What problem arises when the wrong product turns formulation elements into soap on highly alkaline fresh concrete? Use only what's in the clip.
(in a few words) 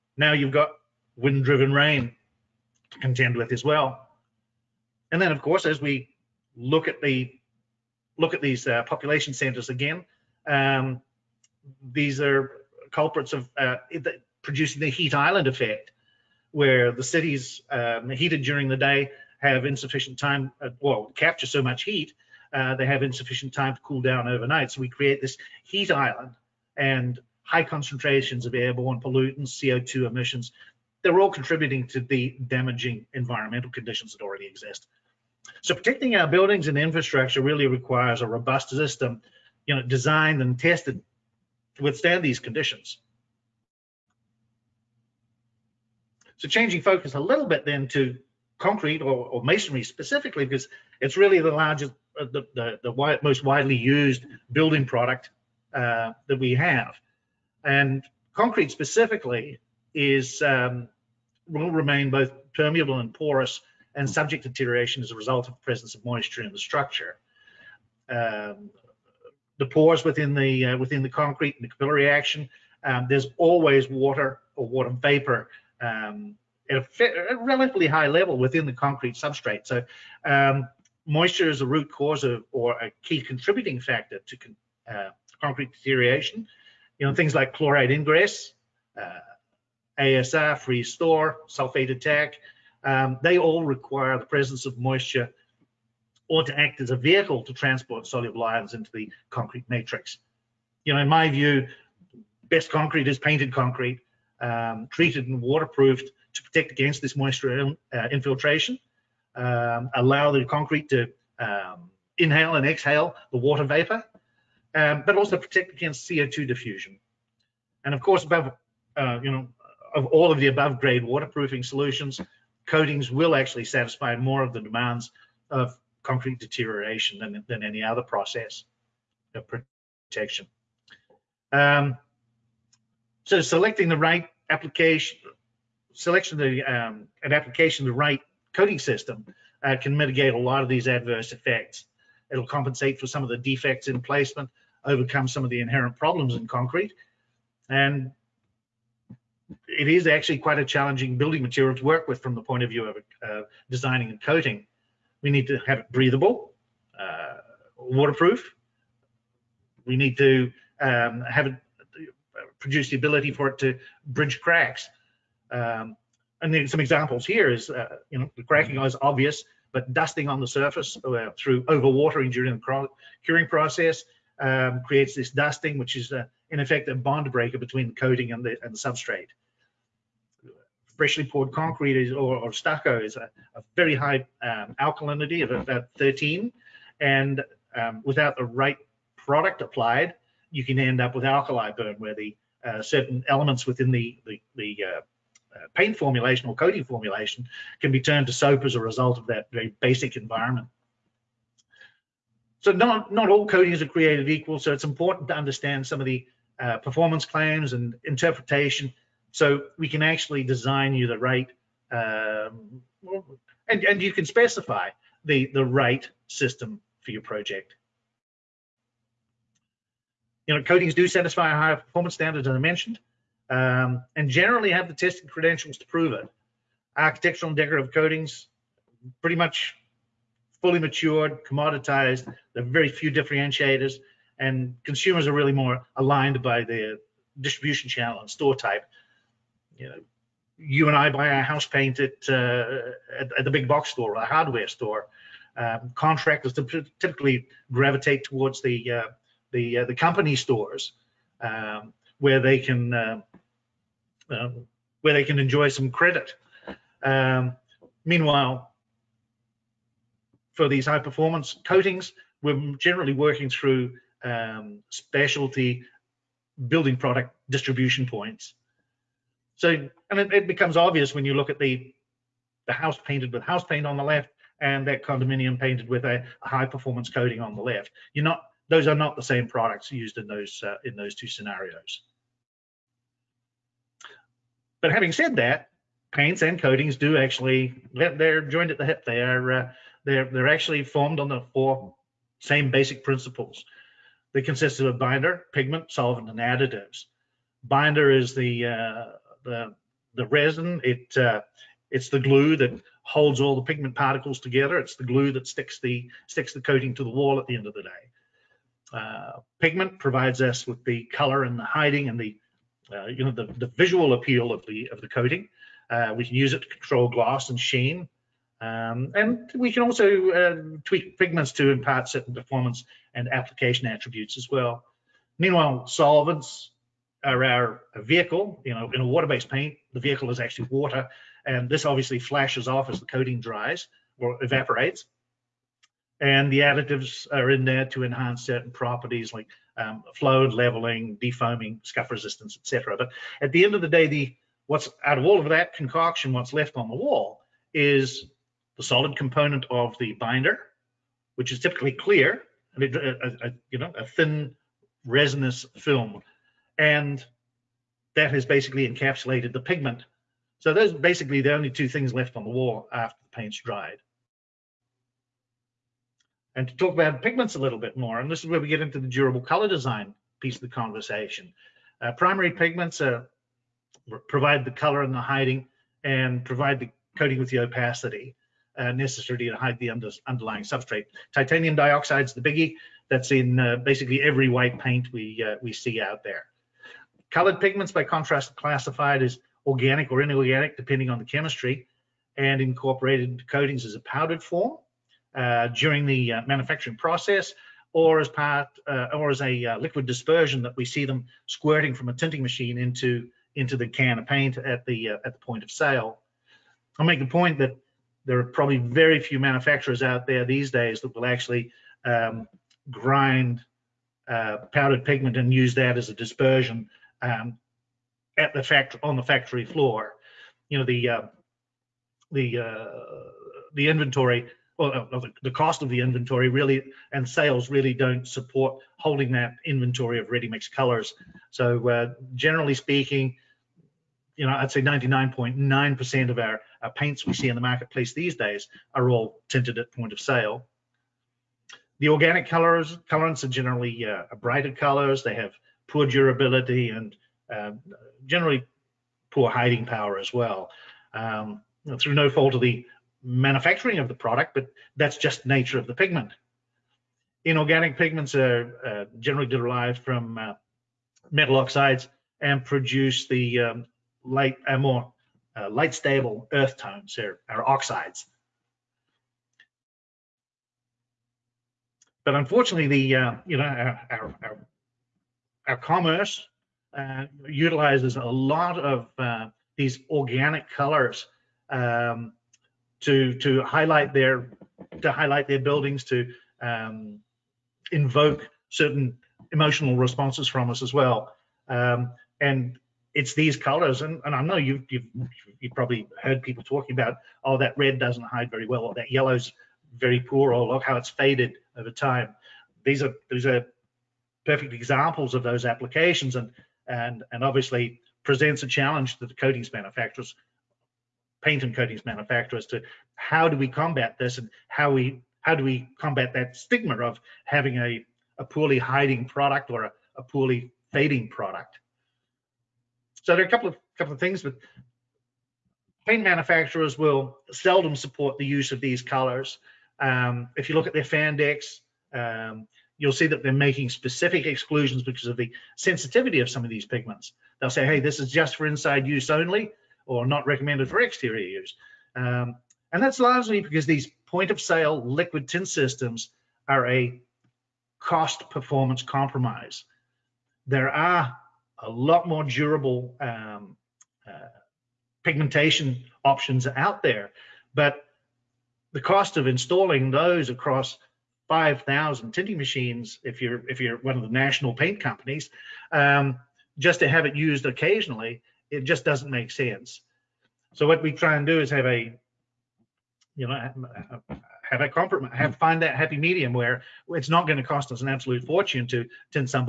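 alkali burn.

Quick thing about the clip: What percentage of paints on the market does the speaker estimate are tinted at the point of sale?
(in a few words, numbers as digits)
99.9%.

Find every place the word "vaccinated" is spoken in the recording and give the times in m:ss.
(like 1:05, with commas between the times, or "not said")
not said.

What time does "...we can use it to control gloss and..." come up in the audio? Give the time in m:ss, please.
5:16.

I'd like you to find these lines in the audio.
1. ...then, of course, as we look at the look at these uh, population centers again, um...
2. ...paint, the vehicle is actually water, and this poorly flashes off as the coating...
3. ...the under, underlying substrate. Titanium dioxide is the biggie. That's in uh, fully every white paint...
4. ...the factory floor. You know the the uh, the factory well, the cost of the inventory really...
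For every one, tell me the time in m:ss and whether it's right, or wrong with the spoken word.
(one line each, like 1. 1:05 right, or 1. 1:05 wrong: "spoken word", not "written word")
1. 0:05 right
2. 5:29 wrong: "obviously", not "poorly"
3. 6:19 wrong: "basically", not "fully"
4. 6:59 wrong: "inventory", not "factory".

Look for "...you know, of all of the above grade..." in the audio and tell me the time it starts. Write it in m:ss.
1:59.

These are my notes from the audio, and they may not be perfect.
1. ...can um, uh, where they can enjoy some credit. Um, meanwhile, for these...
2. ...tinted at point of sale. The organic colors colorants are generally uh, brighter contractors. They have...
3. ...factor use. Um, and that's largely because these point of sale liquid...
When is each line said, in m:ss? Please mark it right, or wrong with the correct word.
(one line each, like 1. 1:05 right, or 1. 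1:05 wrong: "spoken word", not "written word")
1. 4:12 right
2. 7:19 wrong: "colors", not "contractors"
3. 9:00 wrong: "exterior", not "factor".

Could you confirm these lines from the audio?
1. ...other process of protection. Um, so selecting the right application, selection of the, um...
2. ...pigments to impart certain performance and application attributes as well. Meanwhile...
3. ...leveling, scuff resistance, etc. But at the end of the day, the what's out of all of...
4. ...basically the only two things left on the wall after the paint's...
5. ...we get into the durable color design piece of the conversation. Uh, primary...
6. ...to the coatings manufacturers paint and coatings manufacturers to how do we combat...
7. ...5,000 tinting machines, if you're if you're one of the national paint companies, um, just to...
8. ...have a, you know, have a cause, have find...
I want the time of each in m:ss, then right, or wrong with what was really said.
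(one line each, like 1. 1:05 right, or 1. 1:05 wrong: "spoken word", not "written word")
1. 2:07 right
2. 5:21 right
3. 5:41 wrong: "defoaming", not "leveling"
4. 6:00 right
5. 6:08 right
6. 8:29 right
7. 9:21 right
8. 9:31 wrong: "compromise", not "cause".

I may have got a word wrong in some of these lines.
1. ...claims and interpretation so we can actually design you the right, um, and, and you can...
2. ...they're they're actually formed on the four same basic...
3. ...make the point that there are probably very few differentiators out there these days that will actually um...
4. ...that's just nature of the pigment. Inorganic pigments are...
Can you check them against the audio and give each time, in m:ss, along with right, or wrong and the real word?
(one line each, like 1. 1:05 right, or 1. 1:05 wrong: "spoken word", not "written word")
1. 3:27 right
2. 4:50 right
3. 6:47 wrong: "manufacturers", not "differentiators"
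4. 7:34 right.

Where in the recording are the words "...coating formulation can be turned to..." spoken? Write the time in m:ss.
3:16.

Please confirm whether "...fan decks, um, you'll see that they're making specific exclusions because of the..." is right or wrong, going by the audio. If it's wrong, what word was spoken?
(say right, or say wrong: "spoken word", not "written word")
right.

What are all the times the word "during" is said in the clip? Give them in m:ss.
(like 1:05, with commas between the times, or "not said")
0:18, 2:52, 6:35.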